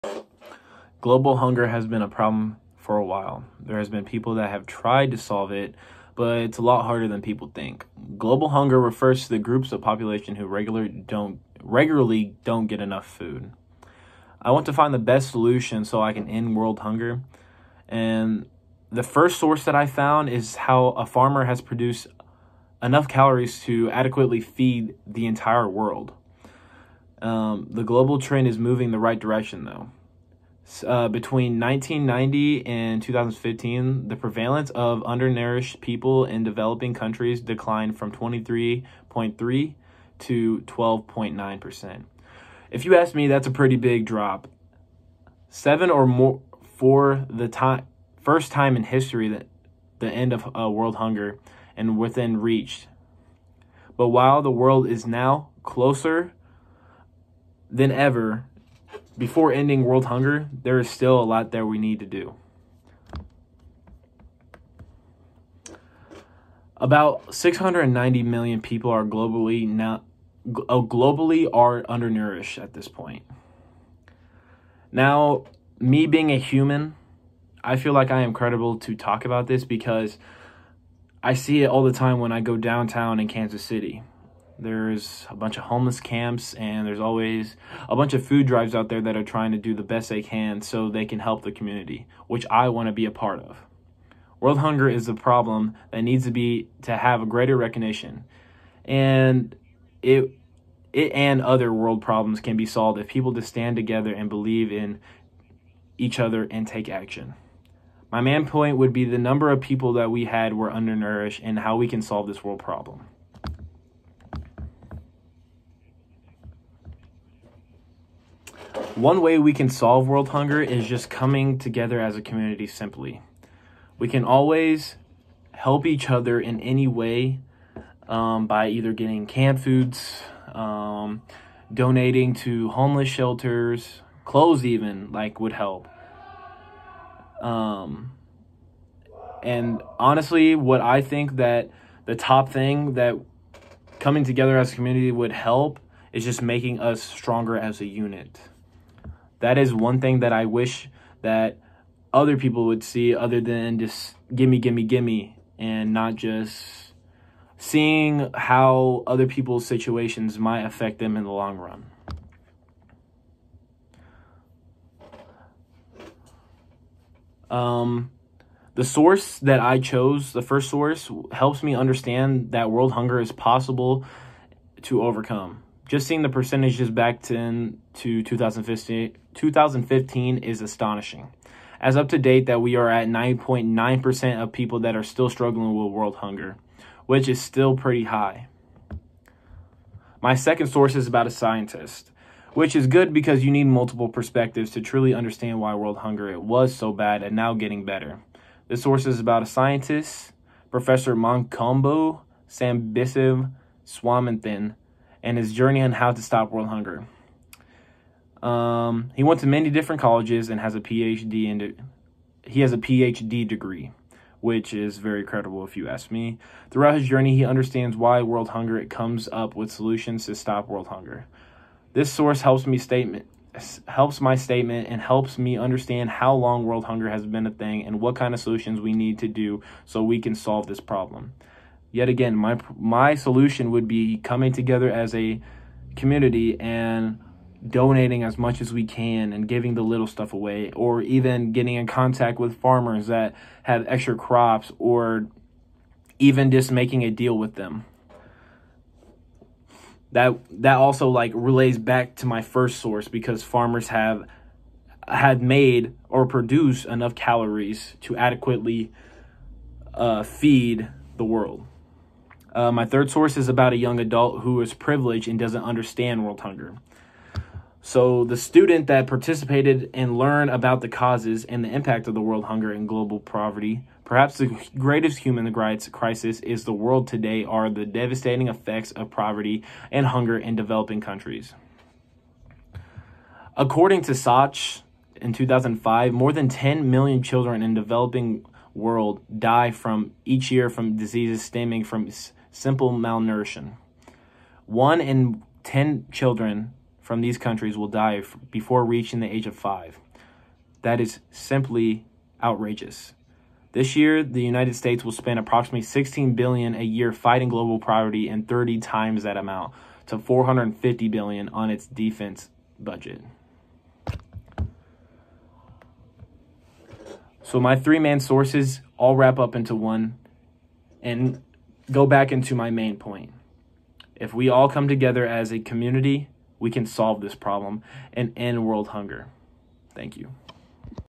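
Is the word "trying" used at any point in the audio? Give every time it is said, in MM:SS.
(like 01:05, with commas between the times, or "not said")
01:29.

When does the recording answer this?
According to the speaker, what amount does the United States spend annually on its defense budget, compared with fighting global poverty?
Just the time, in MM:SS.
05:10.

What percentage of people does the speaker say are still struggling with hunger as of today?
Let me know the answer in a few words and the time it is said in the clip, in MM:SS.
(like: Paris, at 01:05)
9.9%, at 03:03.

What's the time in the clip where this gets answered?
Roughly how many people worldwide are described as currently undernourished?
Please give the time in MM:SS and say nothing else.
01:07.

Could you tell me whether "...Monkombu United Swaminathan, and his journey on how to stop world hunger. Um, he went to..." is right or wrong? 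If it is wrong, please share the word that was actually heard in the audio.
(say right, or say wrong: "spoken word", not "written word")
wrong: "Sambisiv", not "United".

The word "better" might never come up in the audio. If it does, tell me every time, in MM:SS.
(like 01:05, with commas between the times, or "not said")
03:17.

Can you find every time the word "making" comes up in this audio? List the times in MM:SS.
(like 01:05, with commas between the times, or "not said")
02:26, 04:06.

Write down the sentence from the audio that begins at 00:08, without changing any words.
Global hunger refers to the groups of population who regular don't, regularly don't get enough food.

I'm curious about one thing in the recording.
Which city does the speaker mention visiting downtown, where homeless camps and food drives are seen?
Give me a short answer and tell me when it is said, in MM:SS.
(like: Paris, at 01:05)
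Kansas City, at 01:23.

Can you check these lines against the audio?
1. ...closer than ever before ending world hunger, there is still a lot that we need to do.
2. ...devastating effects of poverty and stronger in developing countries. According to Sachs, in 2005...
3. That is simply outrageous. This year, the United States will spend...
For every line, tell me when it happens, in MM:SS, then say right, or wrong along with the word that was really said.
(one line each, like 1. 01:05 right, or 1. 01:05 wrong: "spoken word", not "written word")
1. 00:55 right
2. 04:37 wrong: "hunger", not "stronger"
3. 05:00 right.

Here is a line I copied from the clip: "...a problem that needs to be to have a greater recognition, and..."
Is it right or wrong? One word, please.
right.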